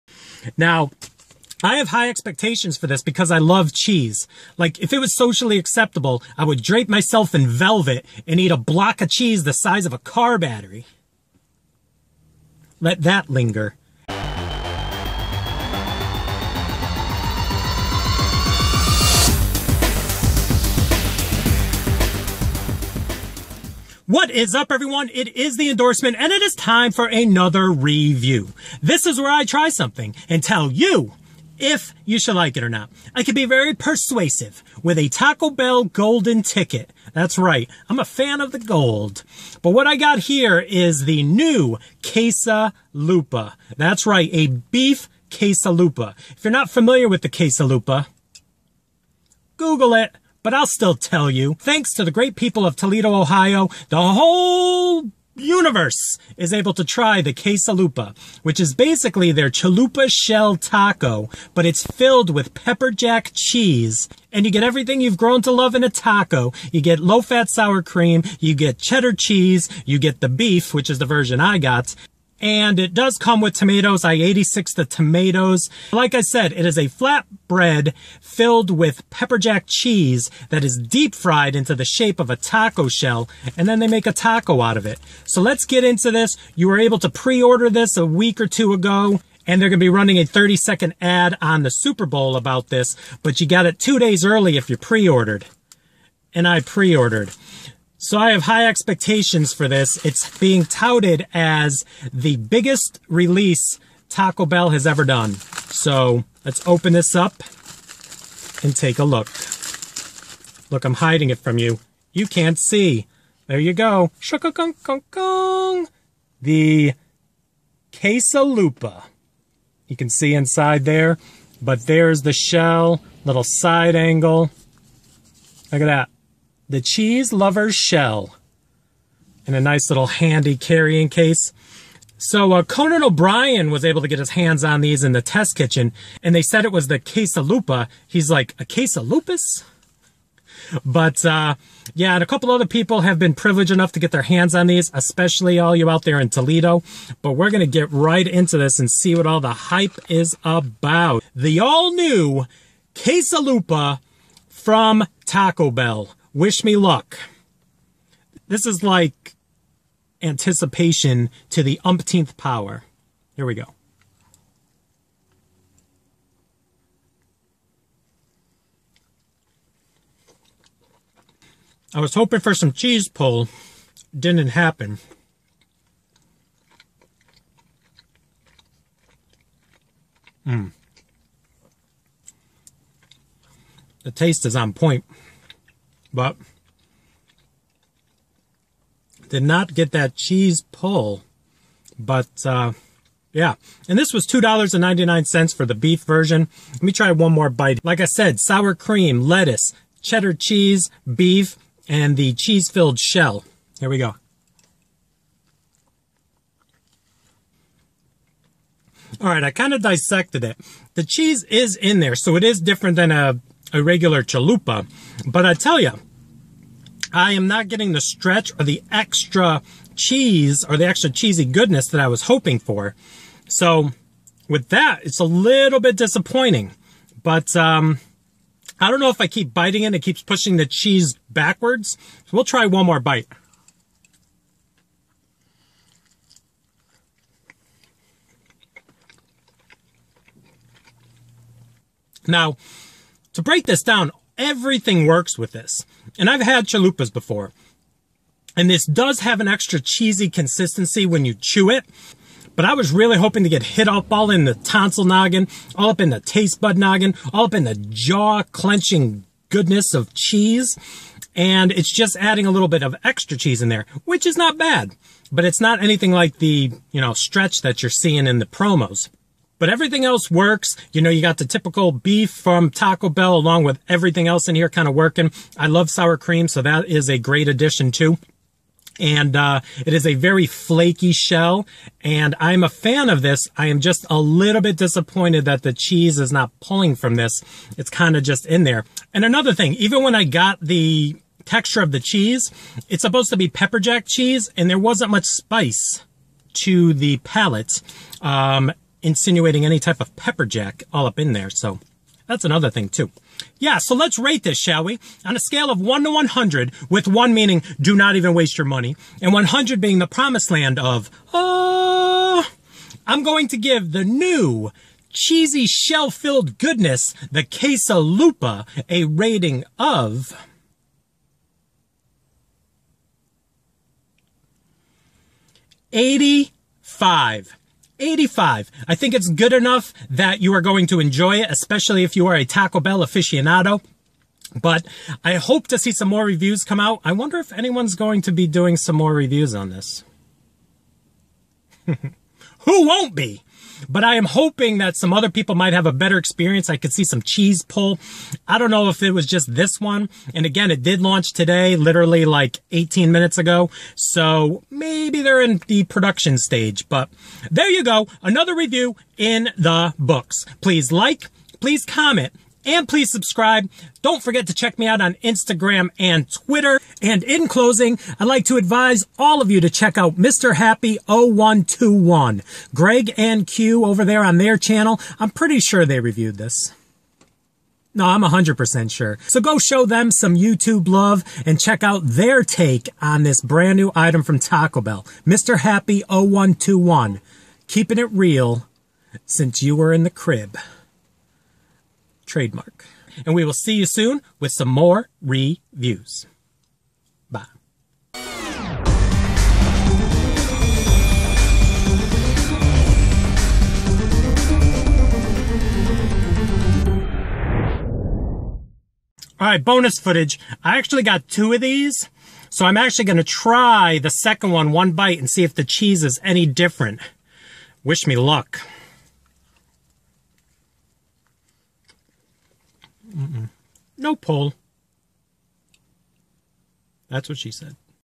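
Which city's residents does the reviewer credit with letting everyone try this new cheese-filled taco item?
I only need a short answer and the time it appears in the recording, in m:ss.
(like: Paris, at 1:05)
Toledo, Ohio, at 0:52.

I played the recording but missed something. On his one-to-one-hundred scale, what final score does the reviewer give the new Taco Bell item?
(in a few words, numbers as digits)
85.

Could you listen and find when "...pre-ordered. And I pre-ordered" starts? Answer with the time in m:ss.
1:34.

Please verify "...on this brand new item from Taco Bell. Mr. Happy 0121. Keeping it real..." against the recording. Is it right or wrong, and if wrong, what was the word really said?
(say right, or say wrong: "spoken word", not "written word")
right.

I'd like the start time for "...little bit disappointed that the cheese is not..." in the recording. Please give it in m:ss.
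4:44.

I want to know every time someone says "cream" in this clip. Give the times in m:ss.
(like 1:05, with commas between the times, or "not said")
1:07, 3:18, 4:36.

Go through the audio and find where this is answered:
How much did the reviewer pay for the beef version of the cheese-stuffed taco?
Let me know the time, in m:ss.
3:14.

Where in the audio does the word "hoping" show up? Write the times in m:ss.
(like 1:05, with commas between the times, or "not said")
2:52, 3:42, 4:13, 5:44.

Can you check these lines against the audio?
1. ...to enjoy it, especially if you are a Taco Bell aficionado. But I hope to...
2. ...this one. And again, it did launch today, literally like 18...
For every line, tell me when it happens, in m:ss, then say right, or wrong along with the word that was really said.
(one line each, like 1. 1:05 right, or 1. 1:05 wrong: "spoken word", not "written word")
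1. 5:30 right
2. 5:49 right.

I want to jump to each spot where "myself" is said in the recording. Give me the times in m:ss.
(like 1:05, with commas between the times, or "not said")
0:06.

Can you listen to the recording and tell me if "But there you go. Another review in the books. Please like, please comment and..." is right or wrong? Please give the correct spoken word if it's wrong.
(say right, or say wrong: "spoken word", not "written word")
right.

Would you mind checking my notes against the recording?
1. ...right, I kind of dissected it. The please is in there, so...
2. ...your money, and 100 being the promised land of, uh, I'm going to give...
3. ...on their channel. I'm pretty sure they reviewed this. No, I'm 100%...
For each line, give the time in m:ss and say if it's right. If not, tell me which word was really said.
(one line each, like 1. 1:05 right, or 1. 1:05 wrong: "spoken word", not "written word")
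1. 3:29 wrong: "cheese", not "please"
2. 5:08 right
3. 6:14 right.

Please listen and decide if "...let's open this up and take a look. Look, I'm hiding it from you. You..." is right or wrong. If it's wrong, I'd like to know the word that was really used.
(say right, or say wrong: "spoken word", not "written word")
right.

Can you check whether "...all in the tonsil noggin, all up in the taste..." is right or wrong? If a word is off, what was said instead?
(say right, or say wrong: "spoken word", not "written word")
right.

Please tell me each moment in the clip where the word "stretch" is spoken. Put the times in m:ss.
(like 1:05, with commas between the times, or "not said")
3:38, 4:27.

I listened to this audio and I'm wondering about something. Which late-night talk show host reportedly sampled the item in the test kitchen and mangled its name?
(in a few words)
Conan O'Brien.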